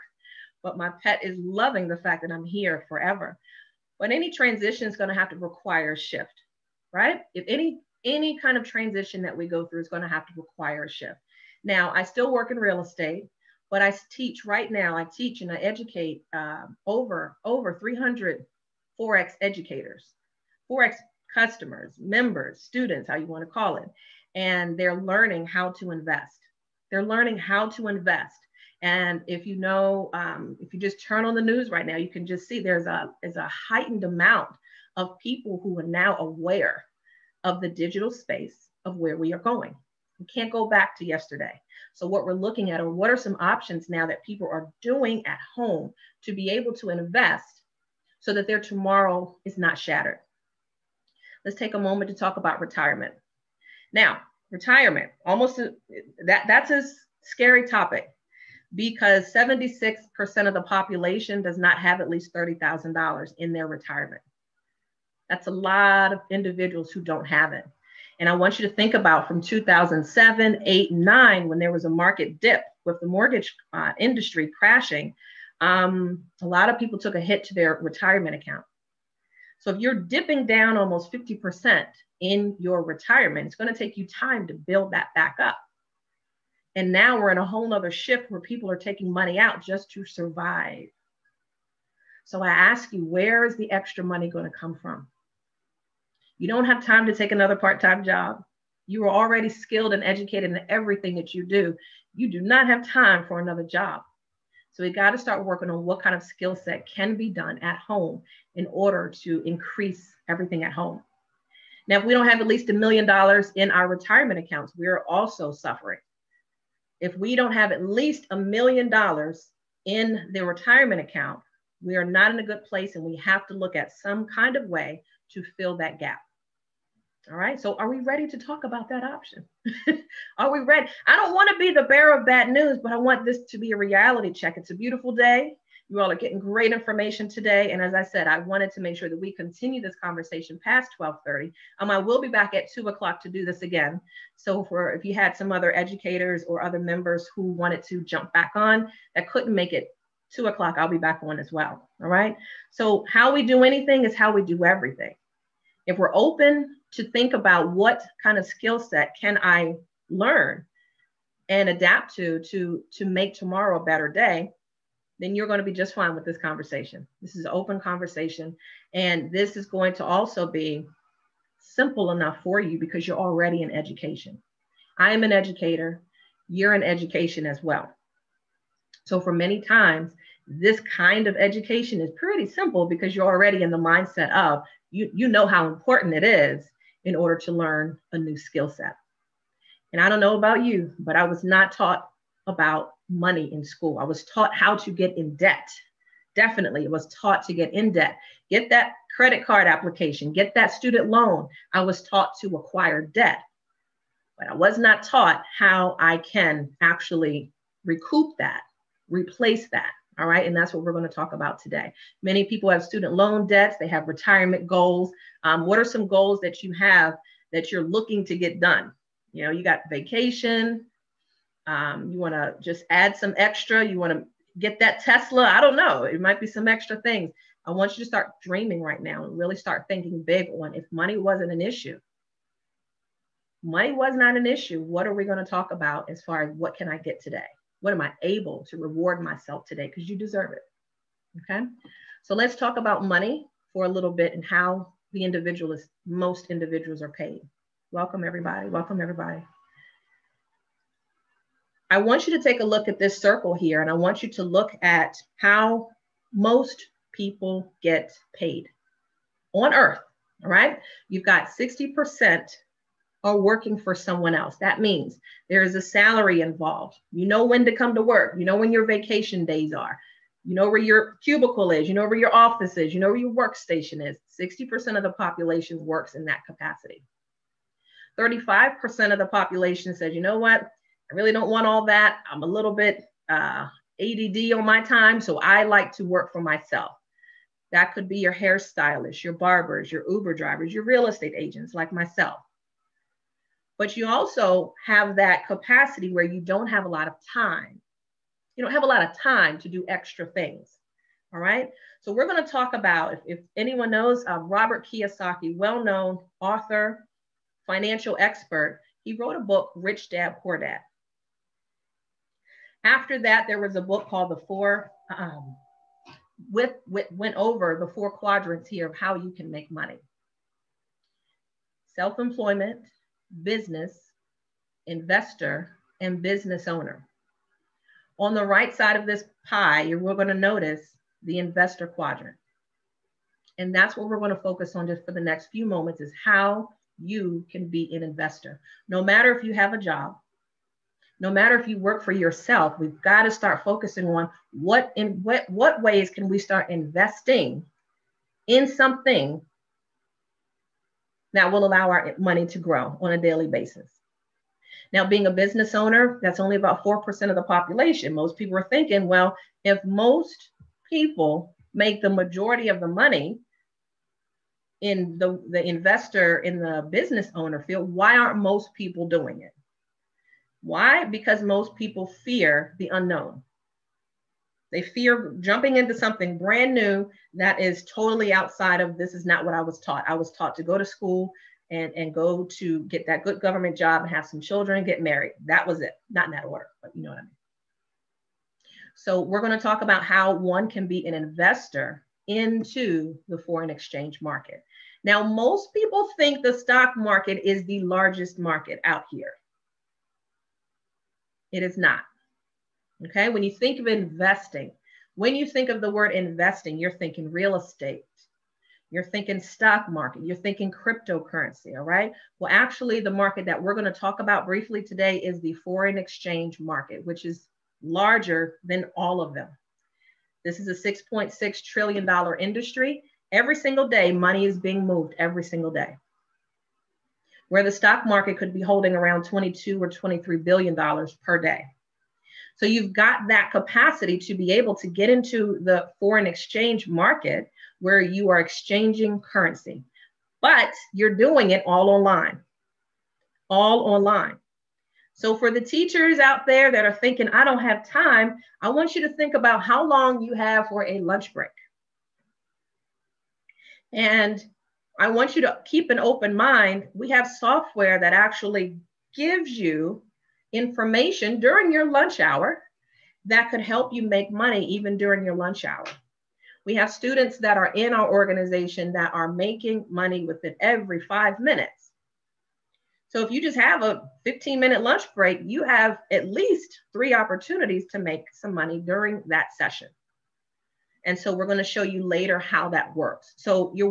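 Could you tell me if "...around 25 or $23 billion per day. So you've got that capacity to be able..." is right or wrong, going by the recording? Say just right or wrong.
wrong.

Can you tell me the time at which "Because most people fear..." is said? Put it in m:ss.
6:11.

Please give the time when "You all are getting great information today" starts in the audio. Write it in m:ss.
2:15.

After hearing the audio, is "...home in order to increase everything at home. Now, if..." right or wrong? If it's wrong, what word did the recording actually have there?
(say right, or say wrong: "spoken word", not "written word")
right.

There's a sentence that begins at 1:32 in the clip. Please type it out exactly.
So I ask you, where is the extra money going to come from?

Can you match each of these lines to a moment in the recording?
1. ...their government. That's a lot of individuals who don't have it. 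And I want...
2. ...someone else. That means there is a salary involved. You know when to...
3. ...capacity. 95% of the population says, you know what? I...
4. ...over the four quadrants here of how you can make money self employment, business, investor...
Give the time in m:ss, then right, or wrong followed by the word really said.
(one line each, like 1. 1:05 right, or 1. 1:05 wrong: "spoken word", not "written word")
1. 1:03 wrong: "retirement", not "government"
2. 4:23 right
3. 4:36 wrong: "35", not "95"
4. 5:17 right.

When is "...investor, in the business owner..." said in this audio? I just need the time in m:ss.
6:05.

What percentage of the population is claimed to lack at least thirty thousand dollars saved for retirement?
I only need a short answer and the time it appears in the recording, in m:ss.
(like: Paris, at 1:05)
76%, at 0:59.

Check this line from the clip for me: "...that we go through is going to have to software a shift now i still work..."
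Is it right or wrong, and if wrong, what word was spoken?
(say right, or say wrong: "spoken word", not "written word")
wrong: "require", not "software".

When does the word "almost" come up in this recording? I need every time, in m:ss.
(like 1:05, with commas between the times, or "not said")
0:55, 1:20.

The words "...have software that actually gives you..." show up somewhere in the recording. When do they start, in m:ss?
7:37.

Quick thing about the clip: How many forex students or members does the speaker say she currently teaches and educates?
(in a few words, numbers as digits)
300.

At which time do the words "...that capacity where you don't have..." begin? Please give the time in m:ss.
4:55.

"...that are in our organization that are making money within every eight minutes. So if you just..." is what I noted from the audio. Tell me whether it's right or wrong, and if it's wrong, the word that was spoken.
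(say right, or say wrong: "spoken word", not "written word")
wrong: "five", not "eight".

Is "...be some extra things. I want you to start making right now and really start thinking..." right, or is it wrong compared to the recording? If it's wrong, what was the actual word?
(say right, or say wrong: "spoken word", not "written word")
wrong: "dreaming", not "making".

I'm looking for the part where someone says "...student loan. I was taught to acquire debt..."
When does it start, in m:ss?
3:20.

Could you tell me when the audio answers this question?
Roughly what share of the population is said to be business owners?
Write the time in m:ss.
5:56.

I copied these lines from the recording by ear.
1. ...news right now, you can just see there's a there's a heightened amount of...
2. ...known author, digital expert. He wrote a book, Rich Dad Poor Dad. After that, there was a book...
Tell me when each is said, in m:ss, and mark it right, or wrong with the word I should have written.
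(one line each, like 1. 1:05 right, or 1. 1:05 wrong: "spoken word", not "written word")
1. 0:31 right
2. 5:05 wrong: "financial", not "digital".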